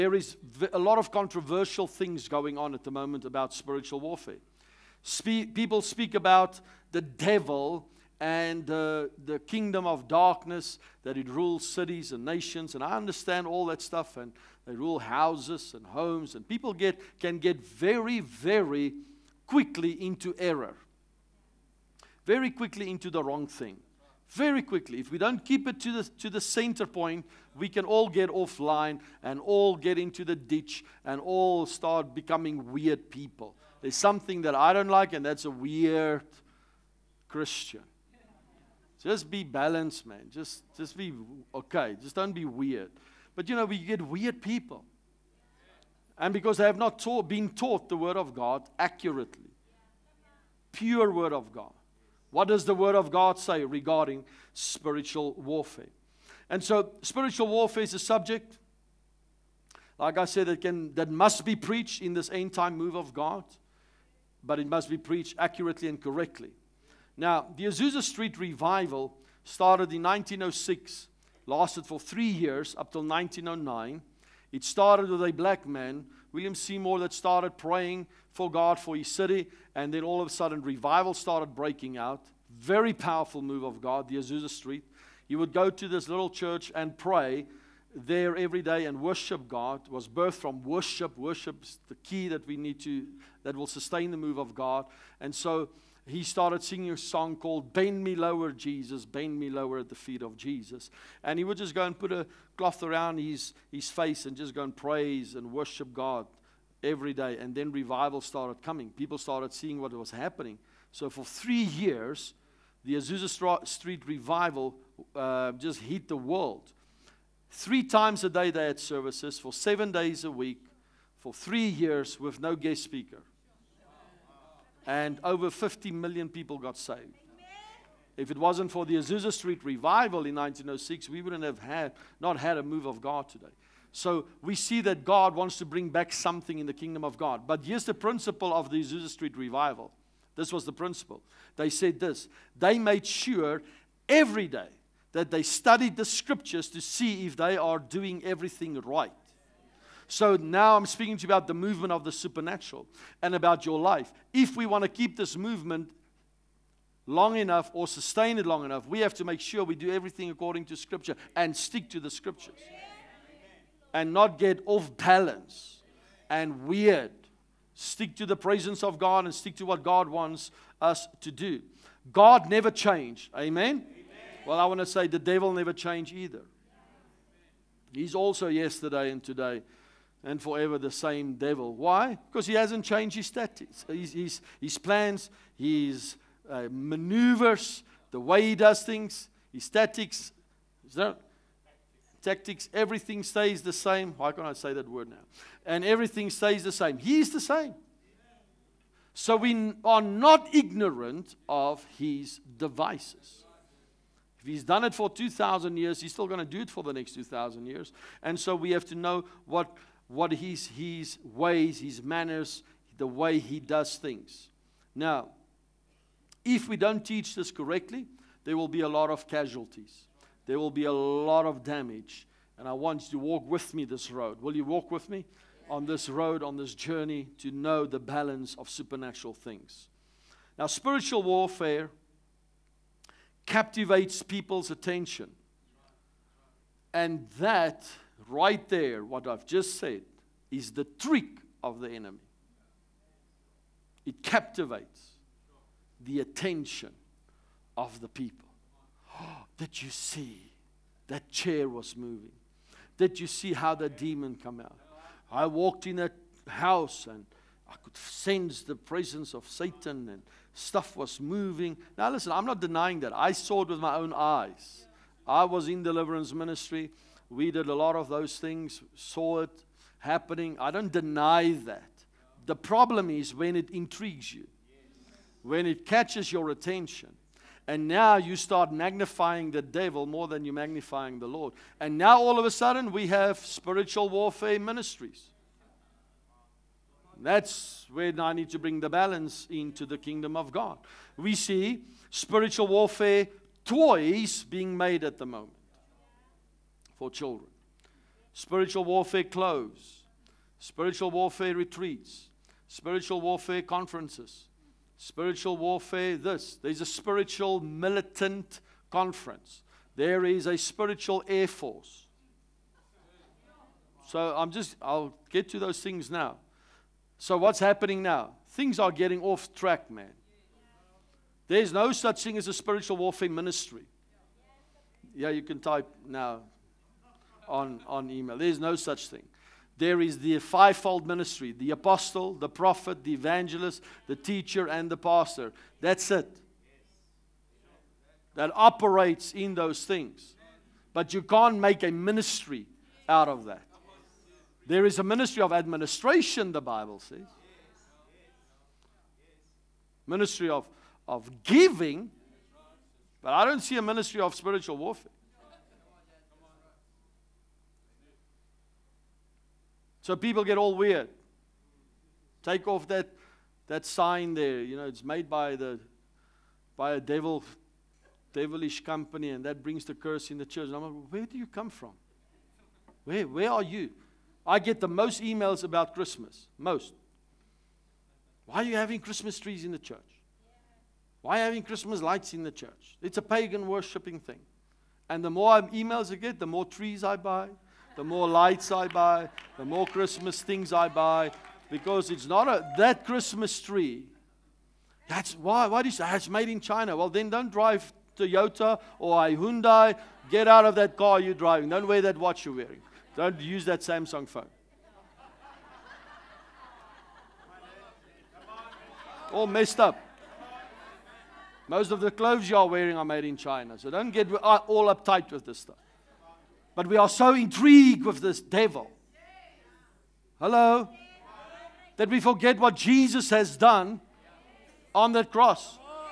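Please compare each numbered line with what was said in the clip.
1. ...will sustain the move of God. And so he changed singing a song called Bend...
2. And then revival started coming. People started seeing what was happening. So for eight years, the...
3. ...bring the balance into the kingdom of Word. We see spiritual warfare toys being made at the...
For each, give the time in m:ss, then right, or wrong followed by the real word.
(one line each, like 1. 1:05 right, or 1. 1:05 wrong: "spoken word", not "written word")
1. 1:33 wrong: "started", not "changed"
2. 1:47 wrong: "three", not "eight"
3. 4:48 wrong: "God", not "Word".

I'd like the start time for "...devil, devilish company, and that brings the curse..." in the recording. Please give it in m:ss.
6:06.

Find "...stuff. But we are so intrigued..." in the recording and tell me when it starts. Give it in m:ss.
6:55.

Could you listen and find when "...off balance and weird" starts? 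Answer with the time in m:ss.
2:44.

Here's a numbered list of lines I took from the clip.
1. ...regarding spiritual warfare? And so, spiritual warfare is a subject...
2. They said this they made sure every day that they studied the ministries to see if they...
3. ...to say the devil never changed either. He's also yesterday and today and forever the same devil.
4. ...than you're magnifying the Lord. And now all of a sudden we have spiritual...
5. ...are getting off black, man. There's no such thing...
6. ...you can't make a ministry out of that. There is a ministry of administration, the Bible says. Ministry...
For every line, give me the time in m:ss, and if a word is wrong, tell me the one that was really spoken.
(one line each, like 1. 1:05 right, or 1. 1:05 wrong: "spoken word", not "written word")
1. 0:53 right
2. 2:21 wrong: "scriptures", not "ministries"
3. 2:54 right
4. 4:40 right
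5. 5:18 wrong: "track", not "black"
6. 5:41 right.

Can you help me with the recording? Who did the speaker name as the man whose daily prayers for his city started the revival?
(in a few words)
William Seymour.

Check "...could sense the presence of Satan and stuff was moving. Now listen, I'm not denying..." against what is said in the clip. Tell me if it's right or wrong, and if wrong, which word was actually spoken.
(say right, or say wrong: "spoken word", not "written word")
right.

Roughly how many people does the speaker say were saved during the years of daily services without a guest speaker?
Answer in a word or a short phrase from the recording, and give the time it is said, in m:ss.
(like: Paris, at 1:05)
50 million, at 2:05.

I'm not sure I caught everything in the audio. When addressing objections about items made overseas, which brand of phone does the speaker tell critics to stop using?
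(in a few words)
Samsung.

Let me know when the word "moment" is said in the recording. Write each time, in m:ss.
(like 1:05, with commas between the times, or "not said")
0:02, 4:55.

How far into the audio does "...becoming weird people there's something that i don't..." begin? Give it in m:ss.
0:32.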